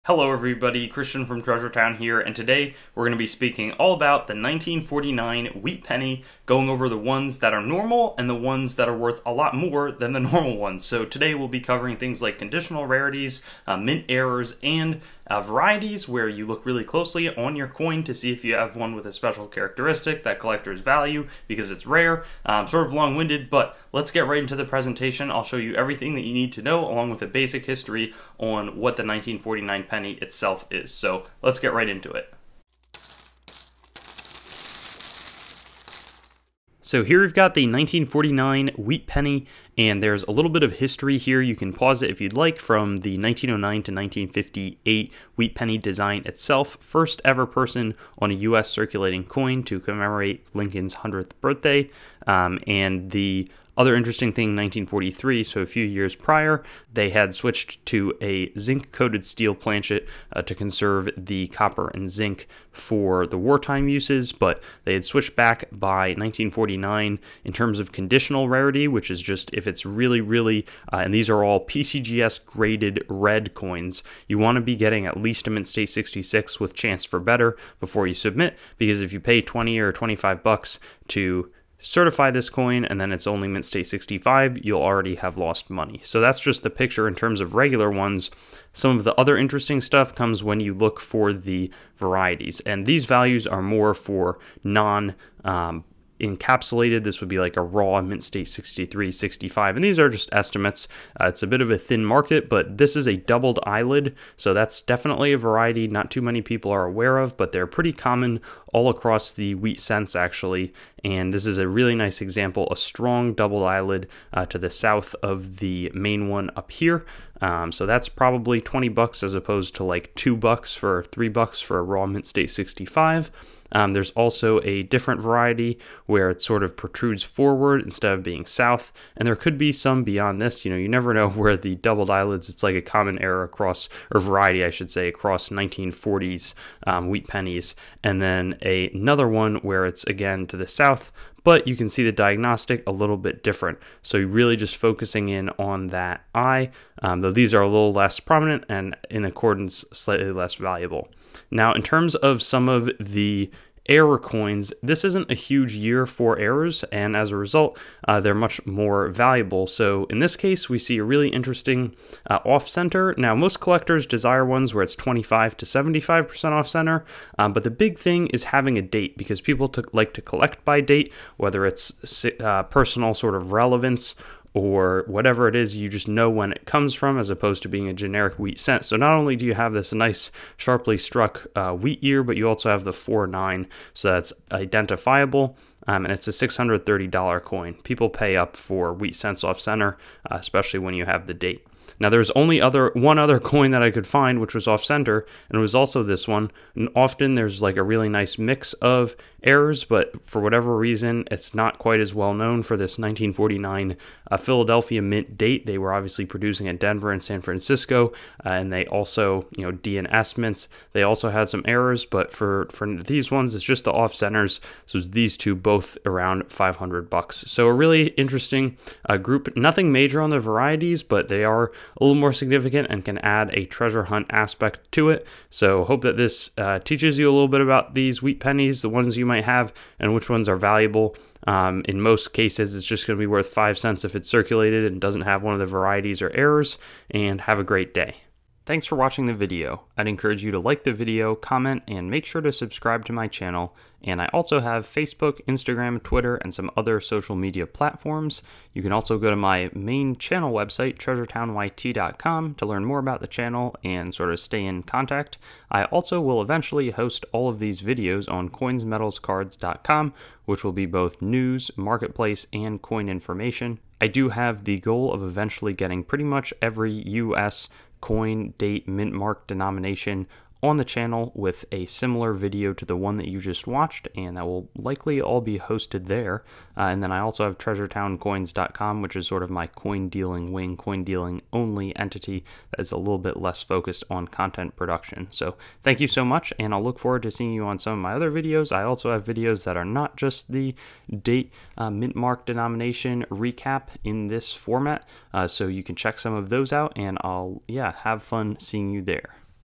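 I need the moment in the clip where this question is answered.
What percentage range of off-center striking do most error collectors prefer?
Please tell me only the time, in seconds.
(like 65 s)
164 s.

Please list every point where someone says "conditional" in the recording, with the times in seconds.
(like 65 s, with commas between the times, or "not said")
12 s, 67 s.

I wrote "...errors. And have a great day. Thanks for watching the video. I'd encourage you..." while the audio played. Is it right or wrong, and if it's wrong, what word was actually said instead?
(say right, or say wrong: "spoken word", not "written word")
right.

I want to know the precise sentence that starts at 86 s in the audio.
So that's just the picture in terms of regular ones.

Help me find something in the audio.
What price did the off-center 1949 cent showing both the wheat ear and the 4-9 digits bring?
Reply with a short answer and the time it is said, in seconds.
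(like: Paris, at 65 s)
$630, at 186 s.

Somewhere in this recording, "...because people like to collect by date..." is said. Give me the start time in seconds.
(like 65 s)
169 s.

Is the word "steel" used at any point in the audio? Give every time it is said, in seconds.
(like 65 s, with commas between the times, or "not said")
59 s.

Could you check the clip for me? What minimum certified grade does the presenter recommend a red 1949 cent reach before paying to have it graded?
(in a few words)
Mint State 66.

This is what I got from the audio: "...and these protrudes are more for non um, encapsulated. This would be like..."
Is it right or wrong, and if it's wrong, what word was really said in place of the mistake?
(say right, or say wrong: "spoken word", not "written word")
wrong: "values", not "protrudes".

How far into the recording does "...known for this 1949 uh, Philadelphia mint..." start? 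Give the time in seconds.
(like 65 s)
202 s.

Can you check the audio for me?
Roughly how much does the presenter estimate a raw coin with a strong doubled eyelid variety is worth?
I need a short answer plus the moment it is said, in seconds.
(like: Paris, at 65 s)
$20, at 118 s.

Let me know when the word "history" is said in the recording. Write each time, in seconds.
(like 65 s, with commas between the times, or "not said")
27 s, 40 s.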